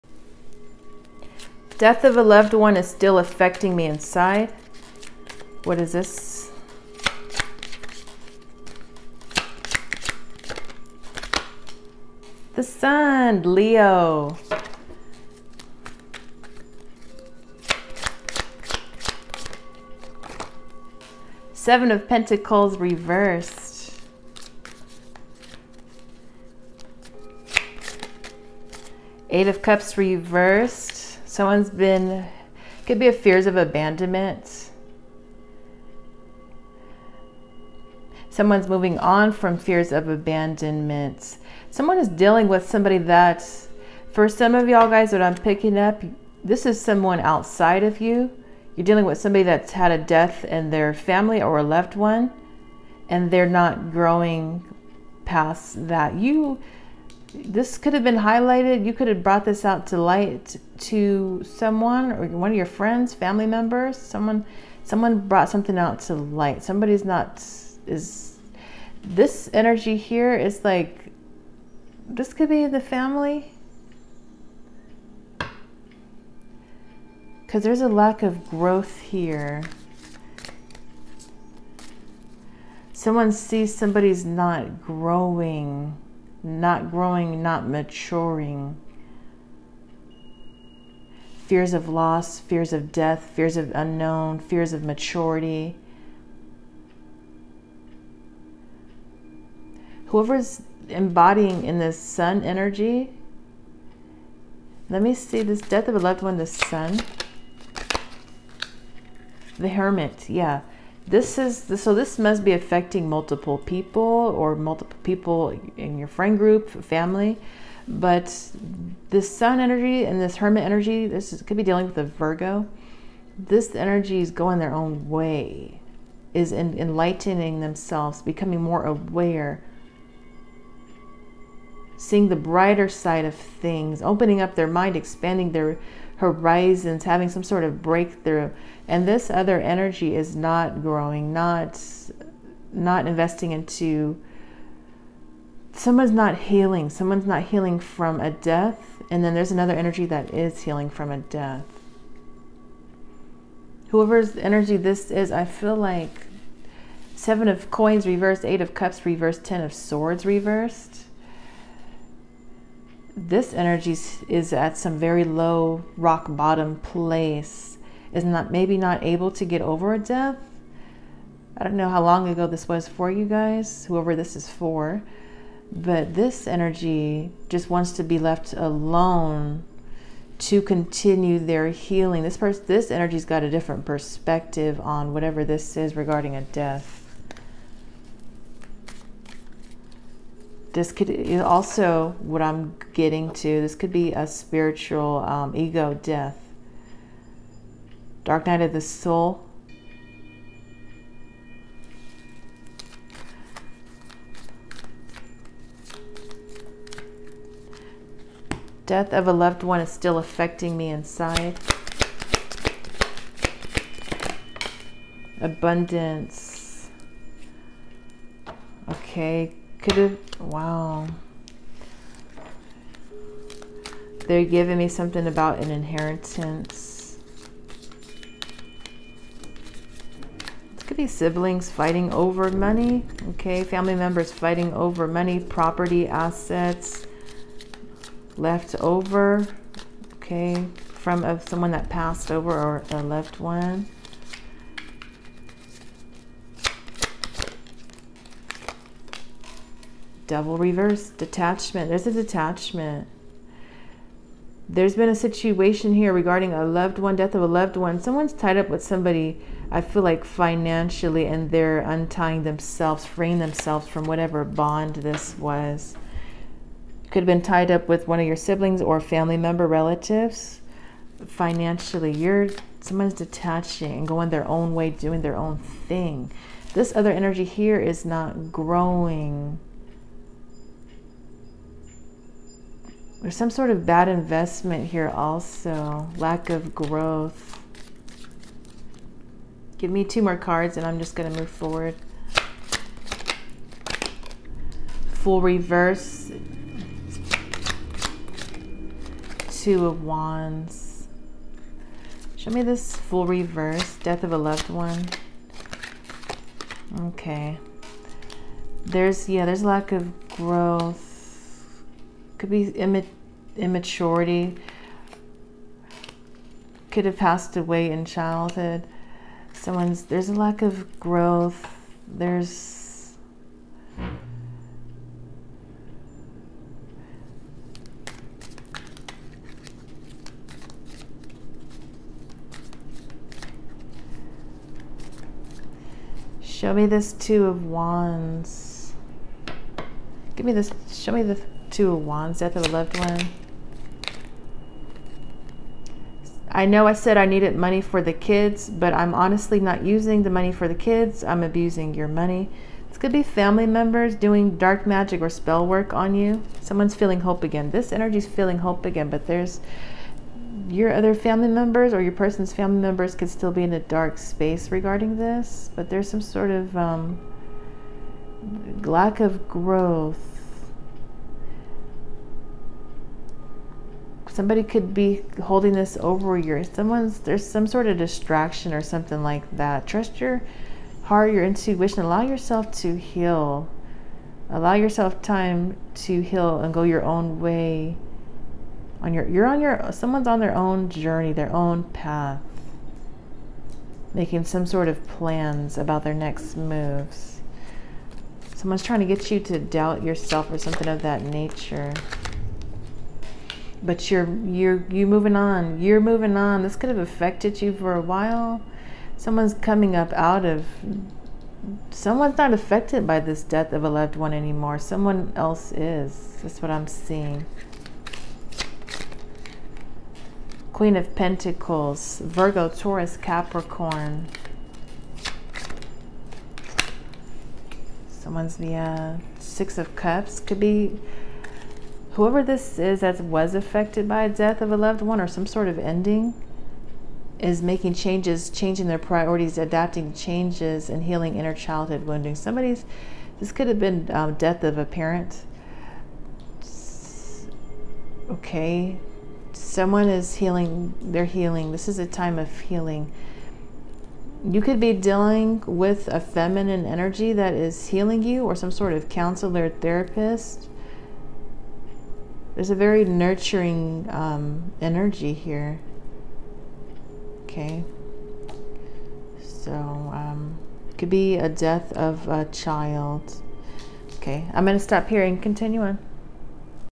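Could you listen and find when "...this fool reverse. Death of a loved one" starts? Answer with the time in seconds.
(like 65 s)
302 s.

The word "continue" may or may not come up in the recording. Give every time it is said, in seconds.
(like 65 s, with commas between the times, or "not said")
180 s, 475 s.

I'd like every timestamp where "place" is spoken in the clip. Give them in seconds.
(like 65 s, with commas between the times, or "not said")
166 s.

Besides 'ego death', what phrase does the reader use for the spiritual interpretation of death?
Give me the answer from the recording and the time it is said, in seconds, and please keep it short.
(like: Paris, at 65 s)
dark night of the soul, at 198 s.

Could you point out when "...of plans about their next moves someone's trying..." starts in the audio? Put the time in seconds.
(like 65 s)
394 s.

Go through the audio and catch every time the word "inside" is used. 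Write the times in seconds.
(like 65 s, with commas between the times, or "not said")
3 s, 210 s.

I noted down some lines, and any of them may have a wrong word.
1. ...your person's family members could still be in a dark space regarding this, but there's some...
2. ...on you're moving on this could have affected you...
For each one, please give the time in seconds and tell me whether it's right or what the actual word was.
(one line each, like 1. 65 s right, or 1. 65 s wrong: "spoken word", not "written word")
1. 362 s right
2. 405 s right.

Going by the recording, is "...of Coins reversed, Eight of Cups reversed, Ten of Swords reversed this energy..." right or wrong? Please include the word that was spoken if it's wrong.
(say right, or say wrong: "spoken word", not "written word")
right.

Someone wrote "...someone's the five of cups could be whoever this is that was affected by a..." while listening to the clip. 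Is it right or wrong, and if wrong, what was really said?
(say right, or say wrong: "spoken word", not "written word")
wrong: "six", not "five".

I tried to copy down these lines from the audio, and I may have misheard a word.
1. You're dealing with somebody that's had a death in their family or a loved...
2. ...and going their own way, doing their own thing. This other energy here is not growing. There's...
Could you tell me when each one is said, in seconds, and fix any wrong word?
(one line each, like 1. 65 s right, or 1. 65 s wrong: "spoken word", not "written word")
1. 48 s right
2. 273 s right.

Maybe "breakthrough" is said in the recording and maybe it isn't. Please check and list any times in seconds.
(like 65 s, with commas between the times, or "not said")
137 s.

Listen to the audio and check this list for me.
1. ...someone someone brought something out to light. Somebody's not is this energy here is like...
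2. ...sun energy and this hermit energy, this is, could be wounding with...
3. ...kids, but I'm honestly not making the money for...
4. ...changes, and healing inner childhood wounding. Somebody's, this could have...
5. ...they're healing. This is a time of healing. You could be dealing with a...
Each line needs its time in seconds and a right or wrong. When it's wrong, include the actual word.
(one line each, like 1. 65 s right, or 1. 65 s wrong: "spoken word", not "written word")
1. 63 s right
2. 119 s wrong: "dealing", not "wounding"
3. 348 s wrong: "using", not "making"
4. 440 s right
5. 451 s right.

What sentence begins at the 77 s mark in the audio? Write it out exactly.
Cuz there's a lack of growth here.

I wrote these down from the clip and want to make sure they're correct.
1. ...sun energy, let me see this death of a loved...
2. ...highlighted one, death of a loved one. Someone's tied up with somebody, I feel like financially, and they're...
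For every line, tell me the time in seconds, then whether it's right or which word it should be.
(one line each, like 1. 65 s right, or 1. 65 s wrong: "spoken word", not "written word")
1. 101 s right
2. 256 s wrong: "loved", not "highlighted".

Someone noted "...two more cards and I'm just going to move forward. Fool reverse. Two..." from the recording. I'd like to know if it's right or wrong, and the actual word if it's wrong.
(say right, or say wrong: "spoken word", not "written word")
right.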